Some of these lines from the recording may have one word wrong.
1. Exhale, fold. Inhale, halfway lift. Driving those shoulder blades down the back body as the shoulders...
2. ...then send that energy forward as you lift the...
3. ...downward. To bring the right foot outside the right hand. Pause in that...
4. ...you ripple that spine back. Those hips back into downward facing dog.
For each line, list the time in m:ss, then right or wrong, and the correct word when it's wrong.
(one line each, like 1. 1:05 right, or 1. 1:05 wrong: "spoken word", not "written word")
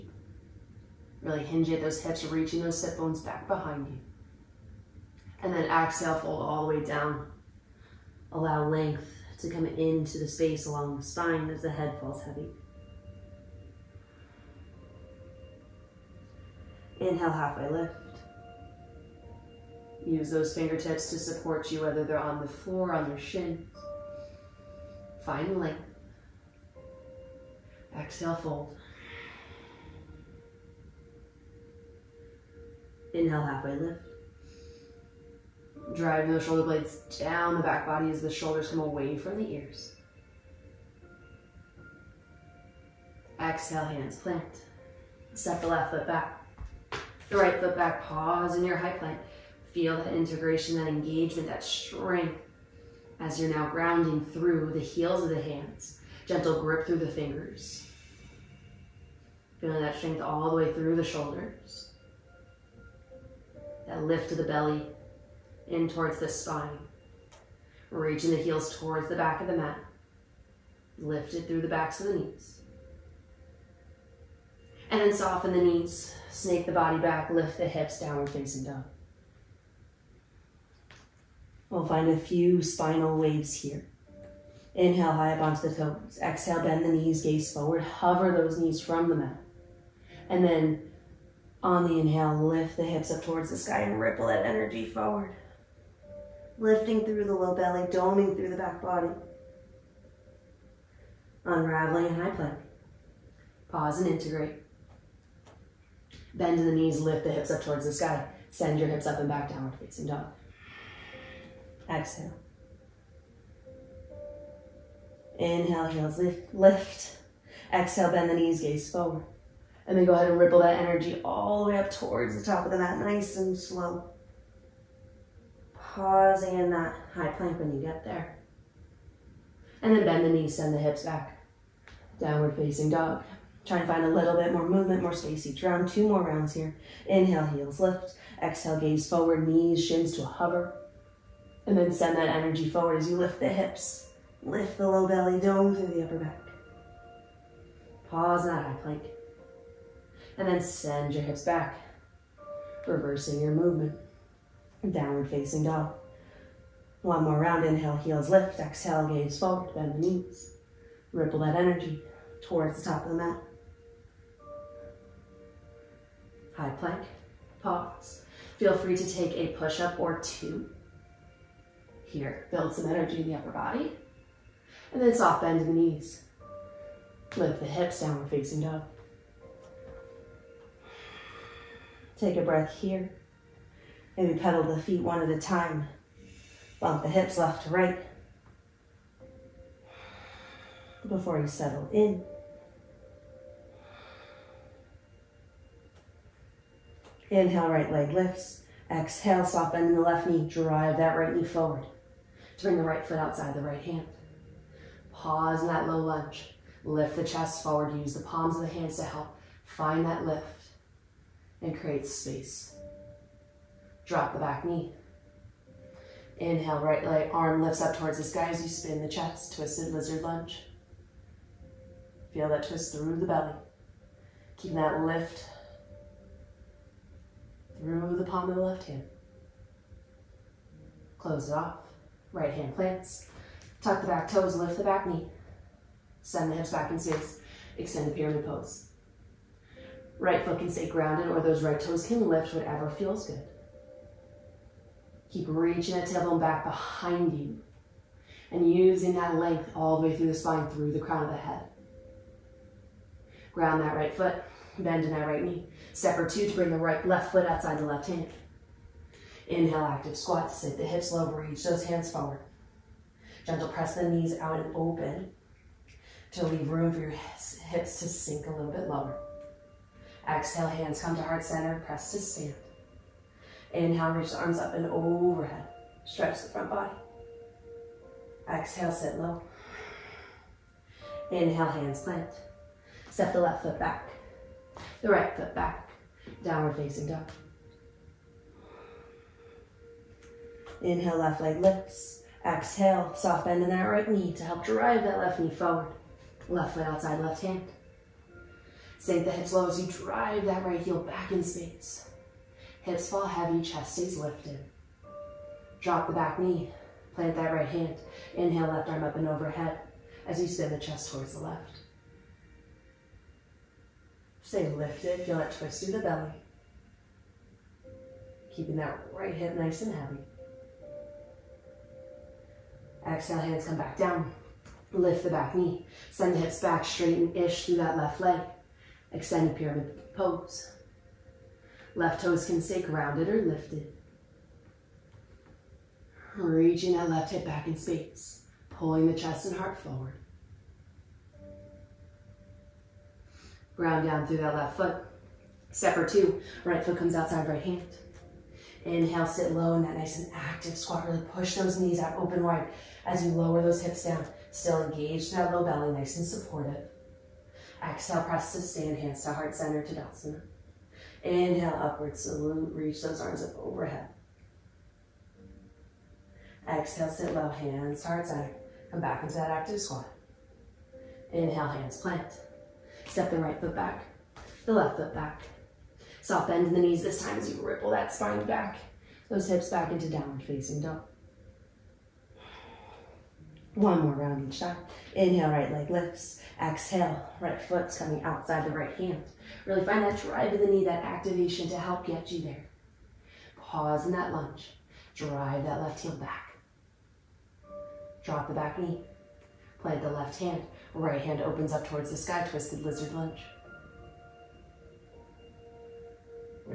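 1. 0:27 right
2. 2:21 right
3. 3:21 wrong: "forward", not "downward"
4. 6:17 right.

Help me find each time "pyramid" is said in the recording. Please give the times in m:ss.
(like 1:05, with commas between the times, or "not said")
3:58, 5:29.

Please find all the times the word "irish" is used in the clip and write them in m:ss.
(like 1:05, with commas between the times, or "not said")
not said.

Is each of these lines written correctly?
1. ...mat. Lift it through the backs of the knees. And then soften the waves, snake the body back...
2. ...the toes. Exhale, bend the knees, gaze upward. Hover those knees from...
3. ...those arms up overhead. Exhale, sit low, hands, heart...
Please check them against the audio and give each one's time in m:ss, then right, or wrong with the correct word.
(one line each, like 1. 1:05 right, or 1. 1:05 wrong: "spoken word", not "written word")
1. 1:09 wrong: "knees", not "waves"
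2. 1:25 wrong: "forward", not "upward"
3. 6:03 right.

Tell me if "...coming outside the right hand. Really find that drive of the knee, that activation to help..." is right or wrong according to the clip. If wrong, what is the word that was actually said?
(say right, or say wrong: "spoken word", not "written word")
right.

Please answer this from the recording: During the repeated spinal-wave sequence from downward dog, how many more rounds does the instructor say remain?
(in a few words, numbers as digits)
2.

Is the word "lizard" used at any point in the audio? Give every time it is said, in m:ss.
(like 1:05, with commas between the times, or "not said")
3:39, 6:42.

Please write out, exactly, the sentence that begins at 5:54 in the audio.
Still engage that low belly, nice and supportive.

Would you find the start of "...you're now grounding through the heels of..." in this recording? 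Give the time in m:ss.
0:53.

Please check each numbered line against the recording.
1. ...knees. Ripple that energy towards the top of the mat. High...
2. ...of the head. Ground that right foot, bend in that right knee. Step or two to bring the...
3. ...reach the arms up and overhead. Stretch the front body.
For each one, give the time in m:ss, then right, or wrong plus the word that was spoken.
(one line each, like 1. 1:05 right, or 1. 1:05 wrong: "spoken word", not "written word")
1. 2:39 right
2. 4:11 right
3. 4:34 right.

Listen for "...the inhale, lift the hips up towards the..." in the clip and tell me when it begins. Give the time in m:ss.
1:31.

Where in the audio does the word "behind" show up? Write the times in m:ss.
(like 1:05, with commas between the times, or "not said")
0:03, 4:06.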